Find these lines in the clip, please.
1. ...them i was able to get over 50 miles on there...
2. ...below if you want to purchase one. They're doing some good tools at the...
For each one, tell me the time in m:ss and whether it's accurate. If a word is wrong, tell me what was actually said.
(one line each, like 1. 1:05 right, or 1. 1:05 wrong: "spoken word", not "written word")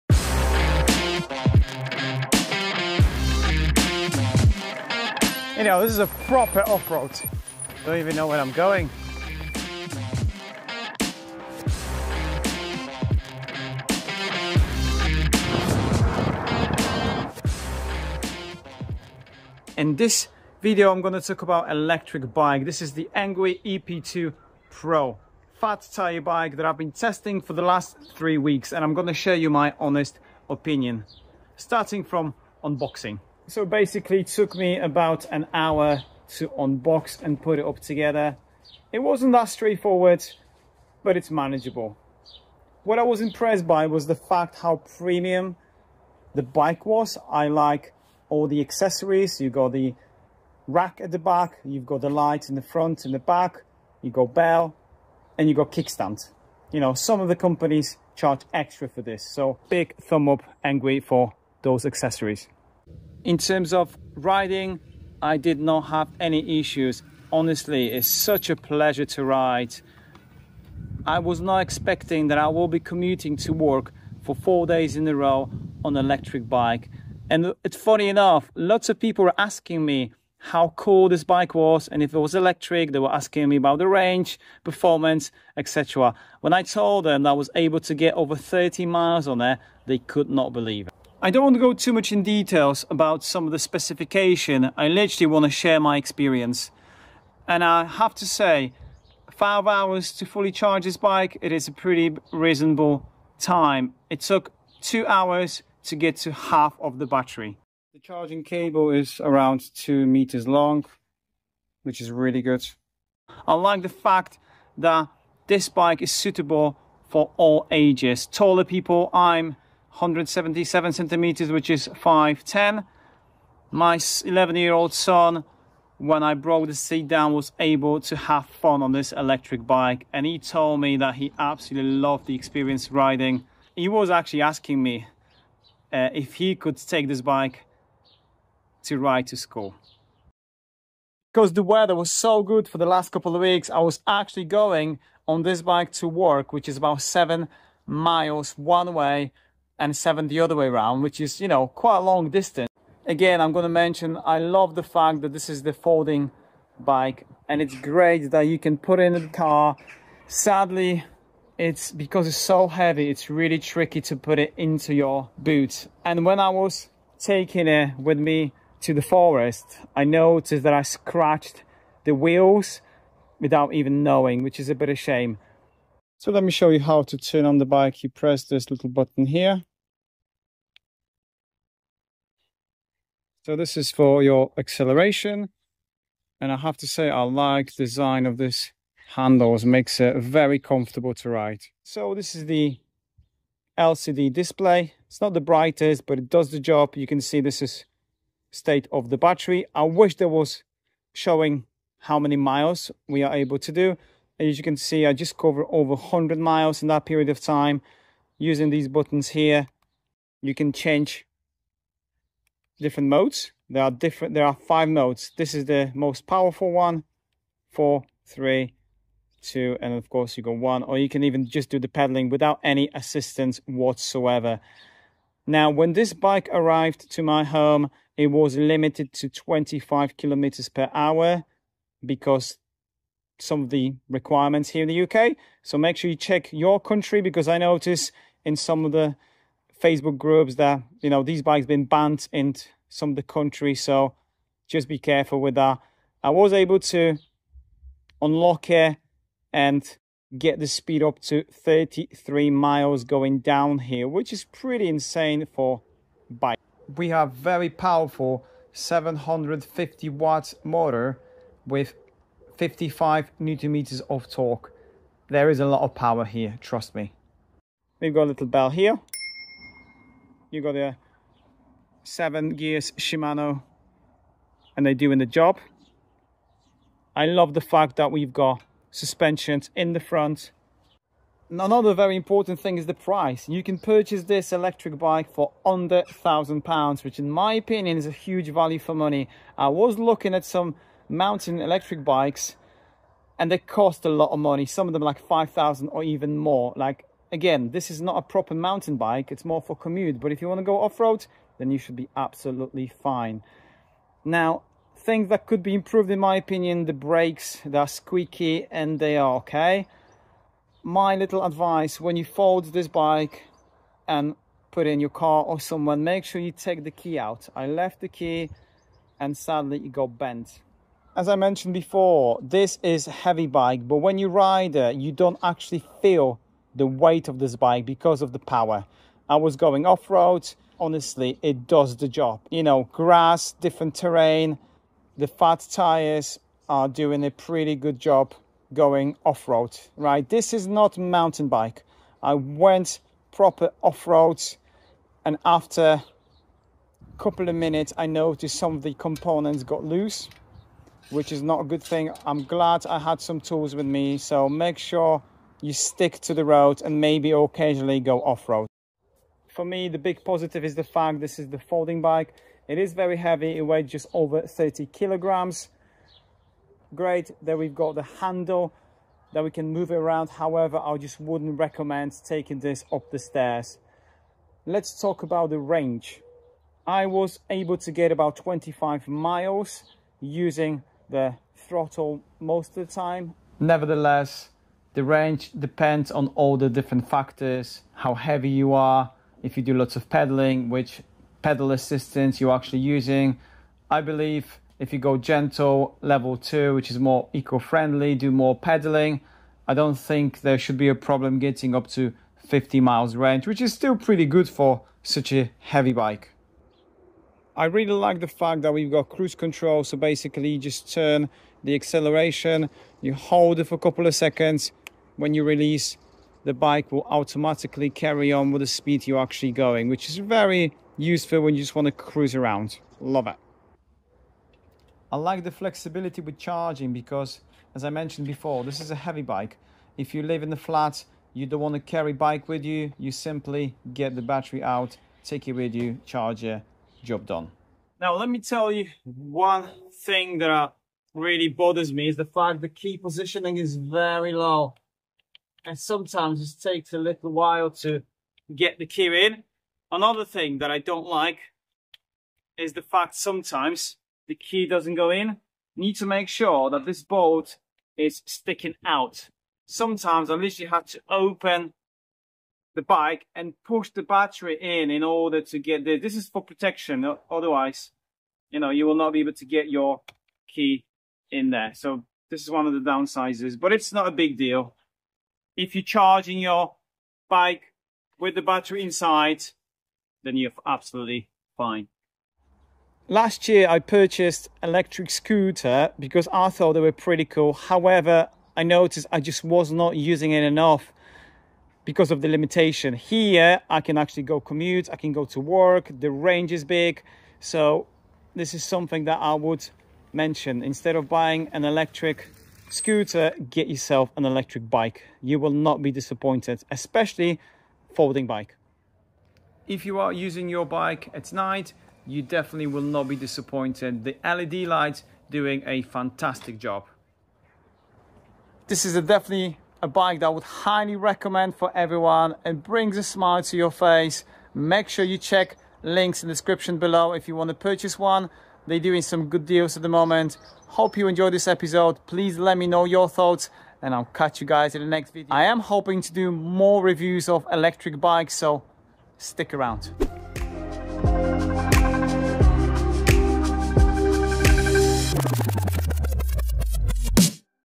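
1. 1:27 wrong: "30", not "50"
2. 8:46 wrong: "deals", not "tools".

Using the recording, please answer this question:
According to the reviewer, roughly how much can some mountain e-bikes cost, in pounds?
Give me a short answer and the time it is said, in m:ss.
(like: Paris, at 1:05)
5,000, at 4:55.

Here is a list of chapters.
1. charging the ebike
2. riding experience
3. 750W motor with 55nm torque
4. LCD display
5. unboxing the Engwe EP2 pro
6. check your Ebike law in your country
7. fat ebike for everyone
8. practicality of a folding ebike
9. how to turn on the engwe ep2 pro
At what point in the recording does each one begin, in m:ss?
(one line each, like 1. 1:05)
1. 1:31
2. 1:02
3. 4:17
4. 3:12
5. 0:33
6. 3:45
7. 1:53
8. 2:20
9. 2:56.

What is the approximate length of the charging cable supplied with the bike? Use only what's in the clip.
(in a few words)
2 meters.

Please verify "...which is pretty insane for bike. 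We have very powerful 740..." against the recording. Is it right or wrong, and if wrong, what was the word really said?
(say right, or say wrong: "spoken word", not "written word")
wrong: "750", not "740".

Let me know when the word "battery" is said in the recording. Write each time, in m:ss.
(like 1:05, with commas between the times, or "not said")
1:47, 3:19, 7:14, 7:44, 7:58.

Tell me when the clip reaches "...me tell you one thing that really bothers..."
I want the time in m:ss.
7:18.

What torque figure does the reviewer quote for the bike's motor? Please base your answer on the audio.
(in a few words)
55 newton meters.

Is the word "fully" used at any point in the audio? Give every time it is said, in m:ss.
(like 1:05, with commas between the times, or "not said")
1:40.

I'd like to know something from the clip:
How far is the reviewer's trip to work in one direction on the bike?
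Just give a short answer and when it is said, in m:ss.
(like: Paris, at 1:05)
7 miles, at 2:27.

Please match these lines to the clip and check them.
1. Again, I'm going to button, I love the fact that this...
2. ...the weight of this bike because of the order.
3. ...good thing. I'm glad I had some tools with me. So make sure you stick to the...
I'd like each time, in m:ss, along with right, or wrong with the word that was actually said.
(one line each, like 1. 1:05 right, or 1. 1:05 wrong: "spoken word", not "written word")
1. 2:33 wrong: "mention", not "button"
2. 5:26 wrong: "power", not "order"
3. 5:51 right.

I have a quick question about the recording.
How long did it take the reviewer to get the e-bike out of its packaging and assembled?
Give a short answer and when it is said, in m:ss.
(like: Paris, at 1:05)
about an hour, at 0:34.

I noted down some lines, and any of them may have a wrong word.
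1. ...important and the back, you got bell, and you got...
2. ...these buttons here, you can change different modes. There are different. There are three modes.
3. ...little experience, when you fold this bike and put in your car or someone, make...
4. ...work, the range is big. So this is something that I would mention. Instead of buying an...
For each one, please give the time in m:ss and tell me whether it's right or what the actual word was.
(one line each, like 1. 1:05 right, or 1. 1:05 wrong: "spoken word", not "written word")
1. 0:52 wrong: "front", not "important"
2. 3:28 wrong: "five", not "three"
3. 5:11 wrong: "advice", not "experience"
4. 8:15 right.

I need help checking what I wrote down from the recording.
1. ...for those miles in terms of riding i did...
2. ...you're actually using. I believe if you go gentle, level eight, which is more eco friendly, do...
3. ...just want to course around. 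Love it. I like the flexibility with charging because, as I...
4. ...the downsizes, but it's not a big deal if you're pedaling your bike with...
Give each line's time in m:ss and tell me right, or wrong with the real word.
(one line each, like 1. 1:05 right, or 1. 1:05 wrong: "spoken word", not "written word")
1. 1:01 wrong: "accessories", not "miles"
2. 6:32 wrong: "two", not "eight"
3. 7:01 wrong: "cruise", not "course"
4. 7:52 wrong: "charging", not "pedaling".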